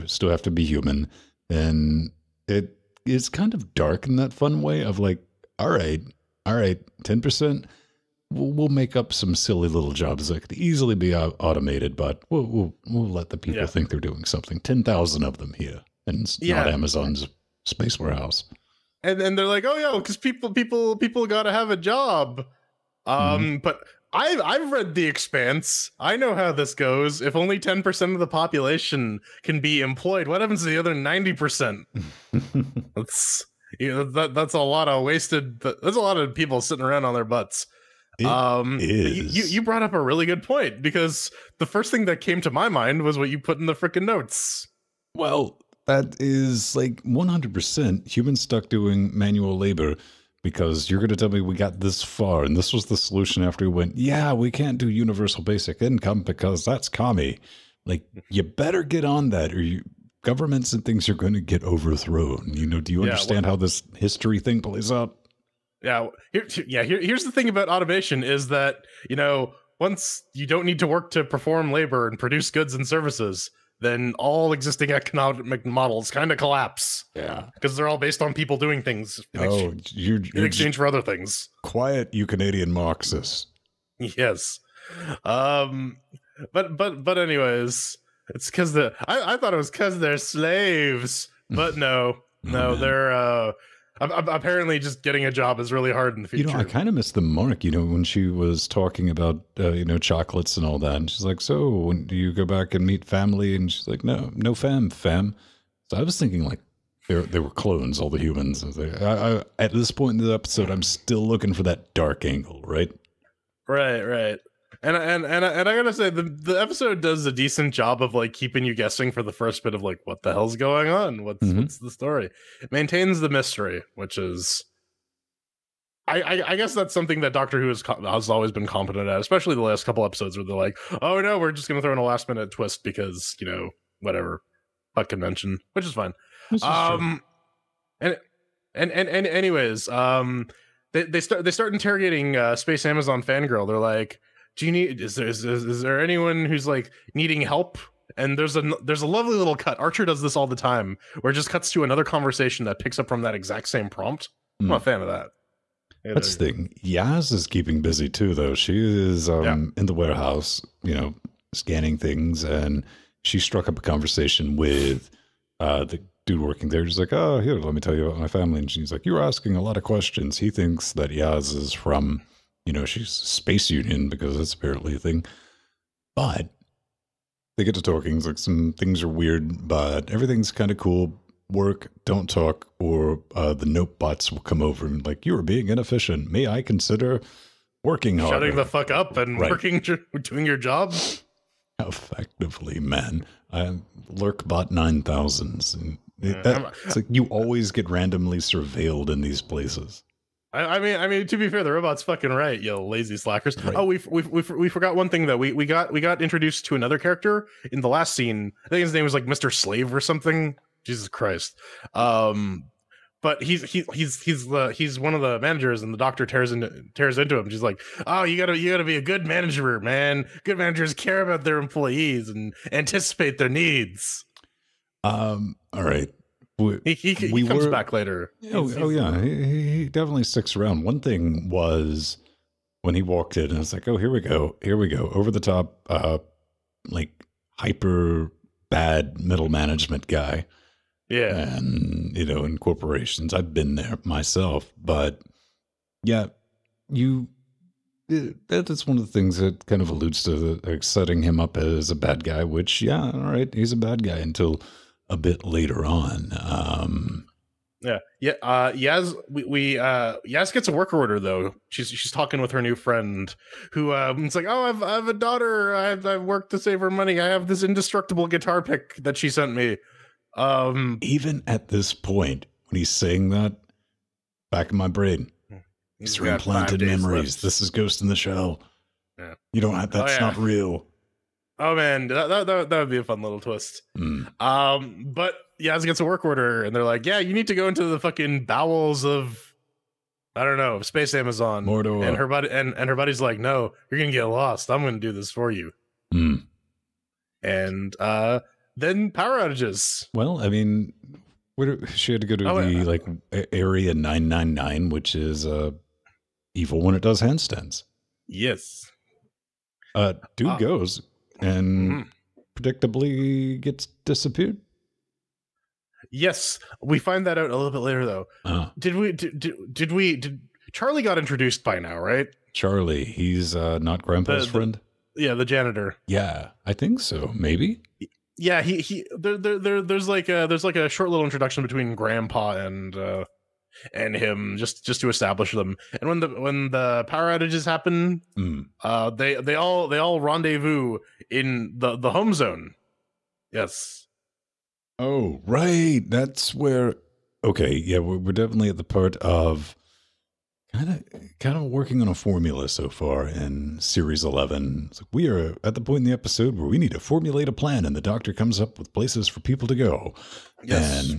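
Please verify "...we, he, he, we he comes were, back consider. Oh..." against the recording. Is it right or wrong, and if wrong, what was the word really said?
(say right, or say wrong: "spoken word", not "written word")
wrong: "later", not "consider".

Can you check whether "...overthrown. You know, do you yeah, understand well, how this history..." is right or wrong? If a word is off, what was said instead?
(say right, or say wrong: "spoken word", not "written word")
right.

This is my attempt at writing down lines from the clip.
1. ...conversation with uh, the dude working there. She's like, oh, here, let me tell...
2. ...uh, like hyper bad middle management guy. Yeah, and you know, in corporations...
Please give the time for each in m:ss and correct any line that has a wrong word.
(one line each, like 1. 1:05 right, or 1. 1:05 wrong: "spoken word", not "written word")
1. 2:43 right
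2. 3:55 right.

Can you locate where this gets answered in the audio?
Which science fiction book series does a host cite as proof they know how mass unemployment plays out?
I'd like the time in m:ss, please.
0:24.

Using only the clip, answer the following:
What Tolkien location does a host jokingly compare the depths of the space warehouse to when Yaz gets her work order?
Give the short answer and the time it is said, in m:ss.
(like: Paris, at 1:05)
Mordor, at 4:51.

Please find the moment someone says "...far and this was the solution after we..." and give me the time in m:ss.
0:52.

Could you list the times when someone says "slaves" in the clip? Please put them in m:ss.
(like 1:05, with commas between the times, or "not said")
1:30, 3:29.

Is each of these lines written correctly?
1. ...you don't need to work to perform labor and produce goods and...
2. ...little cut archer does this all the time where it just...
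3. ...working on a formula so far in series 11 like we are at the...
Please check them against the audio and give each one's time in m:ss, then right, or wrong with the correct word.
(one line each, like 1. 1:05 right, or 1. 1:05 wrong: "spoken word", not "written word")
1. 1:10 right
2. 2:29 right
3. 5:51 right.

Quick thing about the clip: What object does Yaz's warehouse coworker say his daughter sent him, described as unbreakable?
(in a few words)
indestructible guitar pick.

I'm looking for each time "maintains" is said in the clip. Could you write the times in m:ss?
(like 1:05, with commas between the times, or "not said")
2:02.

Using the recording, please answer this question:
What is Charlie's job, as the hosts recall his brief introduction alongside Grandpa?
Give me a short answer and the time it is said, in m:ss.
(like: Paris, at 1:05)
janitor, at 5:25.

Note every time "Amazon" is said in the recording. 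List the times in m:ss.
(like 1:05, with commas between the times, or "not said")
0:16, 2:22, 4:51.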